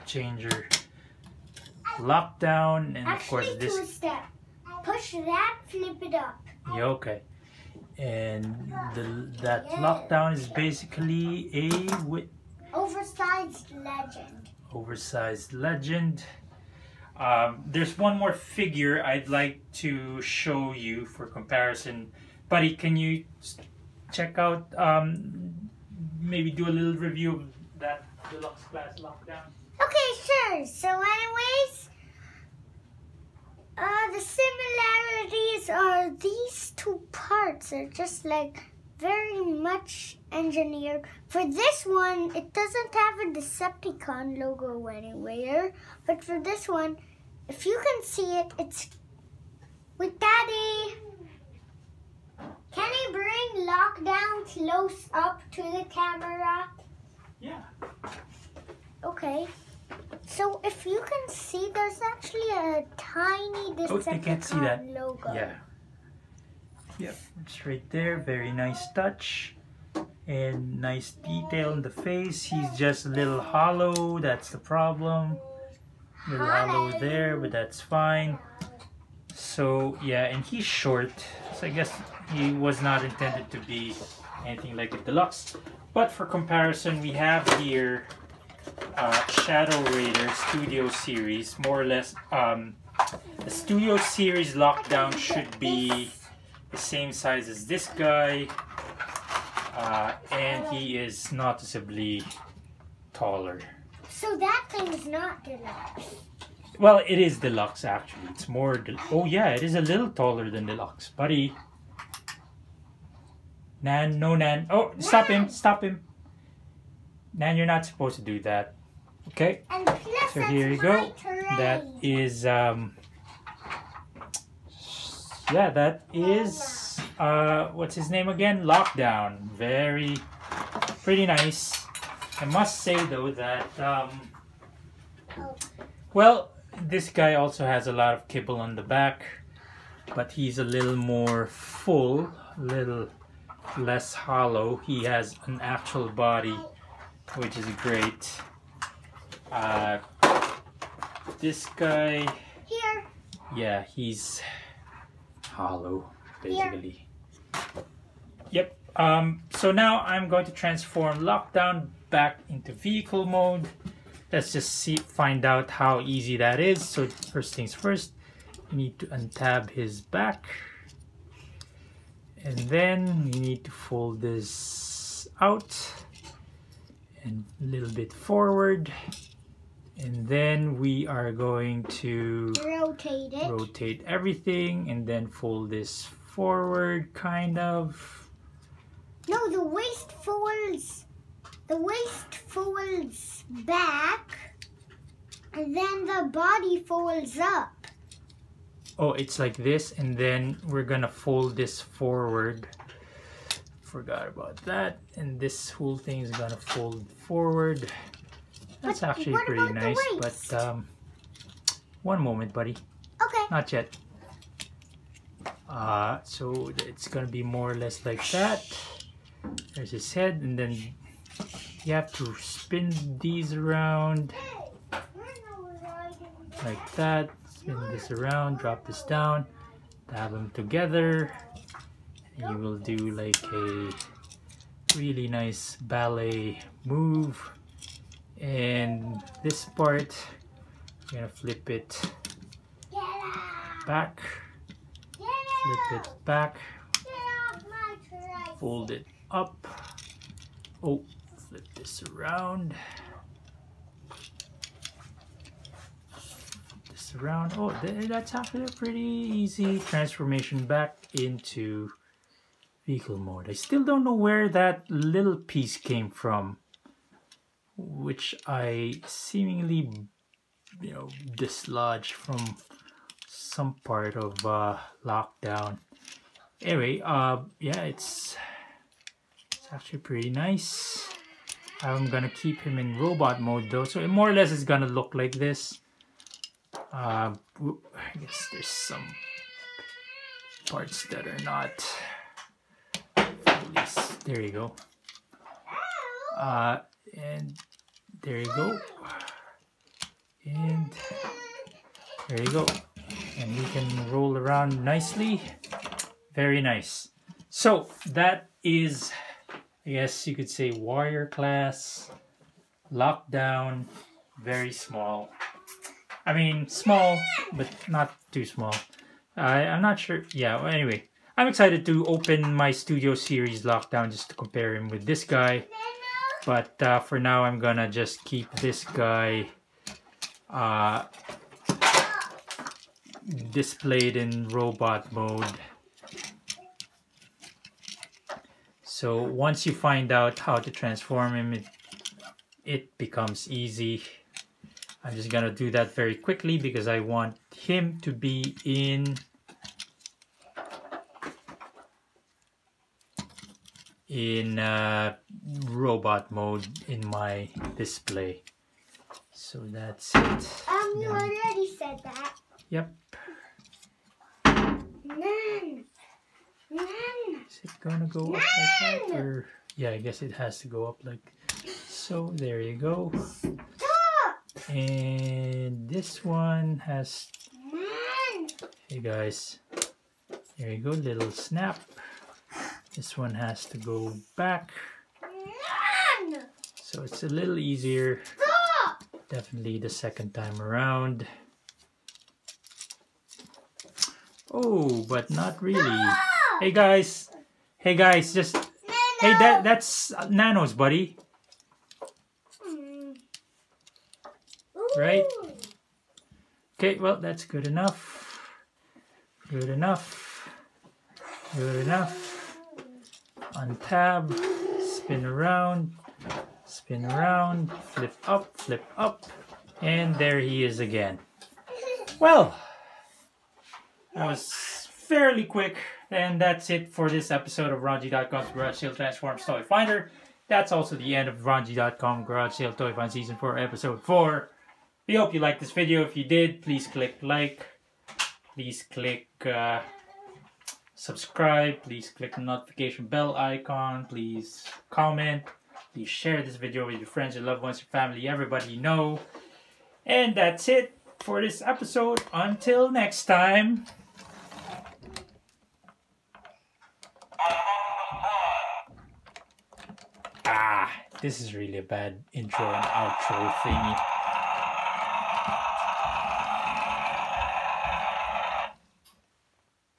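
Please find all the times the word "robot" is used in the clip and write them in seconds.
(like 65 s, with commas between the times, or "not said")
282 s, 334 s, 355 s.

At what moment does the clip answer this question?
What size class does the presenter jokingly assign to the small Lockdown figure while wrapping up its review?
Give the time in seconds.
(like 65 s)
310 s.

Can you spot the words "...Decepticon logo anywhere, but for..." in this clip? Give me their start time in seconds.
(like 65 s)
43 s.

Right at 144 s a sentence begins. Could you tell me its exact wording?
He has an actual body which is great.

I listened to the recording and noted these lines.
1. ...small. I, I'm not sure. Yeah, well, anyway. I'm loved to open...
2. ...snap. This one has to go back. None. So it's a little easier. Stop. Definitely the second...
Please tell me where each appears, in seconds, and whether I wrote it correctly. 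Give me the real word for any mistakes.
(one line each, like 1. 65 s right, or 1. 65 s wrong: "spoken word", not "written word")
1. 318 s wrong: "excited", not "loved"
2. 381 s right.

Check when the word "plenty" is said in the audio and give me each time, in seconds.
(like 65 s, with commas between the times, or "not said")
not said.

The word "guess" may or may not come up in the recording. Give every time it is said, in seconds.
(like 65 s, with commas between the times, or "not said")
81 s, 288 s, 309 s, 369 s.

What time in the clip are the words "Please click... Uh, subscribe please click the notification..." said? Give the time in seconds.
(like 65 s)
438 s.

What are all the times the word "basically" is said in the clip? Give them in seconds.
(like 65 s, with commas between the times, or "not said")
10 s, 156 s.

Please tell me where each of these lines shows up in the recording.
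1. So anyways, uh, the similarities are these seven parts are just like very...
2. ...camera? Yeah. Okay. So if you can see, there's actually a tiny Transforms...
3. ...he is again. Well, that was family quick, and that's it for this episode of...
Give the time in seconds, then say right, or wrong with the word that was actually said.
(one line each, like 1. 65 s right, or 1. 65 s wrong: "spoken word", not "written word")
1. 30 s wrong: "two", not "seven"
2. 55 s wrong: "Decepticon", not "Transforms"
3. 420 s wrong: "fairly", not "family".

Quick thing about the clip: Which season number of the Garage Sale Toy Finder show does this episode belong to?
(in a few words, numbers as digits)
4.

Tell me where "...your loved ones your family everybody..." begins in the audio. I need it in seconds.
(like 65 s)
447 s.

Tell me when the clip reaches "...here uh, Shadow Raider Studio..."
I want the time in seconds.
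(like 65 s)
87 s.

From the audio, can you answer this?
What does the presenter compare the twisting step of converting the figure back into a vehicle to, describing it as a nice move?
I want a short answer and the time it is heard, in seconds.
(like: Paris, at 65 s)
Ballet move, at 235 s.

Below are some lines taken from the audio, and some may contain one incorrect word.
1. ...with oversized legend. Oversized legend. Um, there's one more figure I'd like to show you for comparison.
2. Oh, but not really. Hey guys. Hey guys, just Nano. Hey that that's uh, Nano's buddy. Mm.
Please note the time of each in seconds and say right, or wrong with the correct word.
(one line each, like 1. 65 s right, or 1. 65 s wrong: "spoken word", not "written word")
1. 12 s right
2. 394 s right.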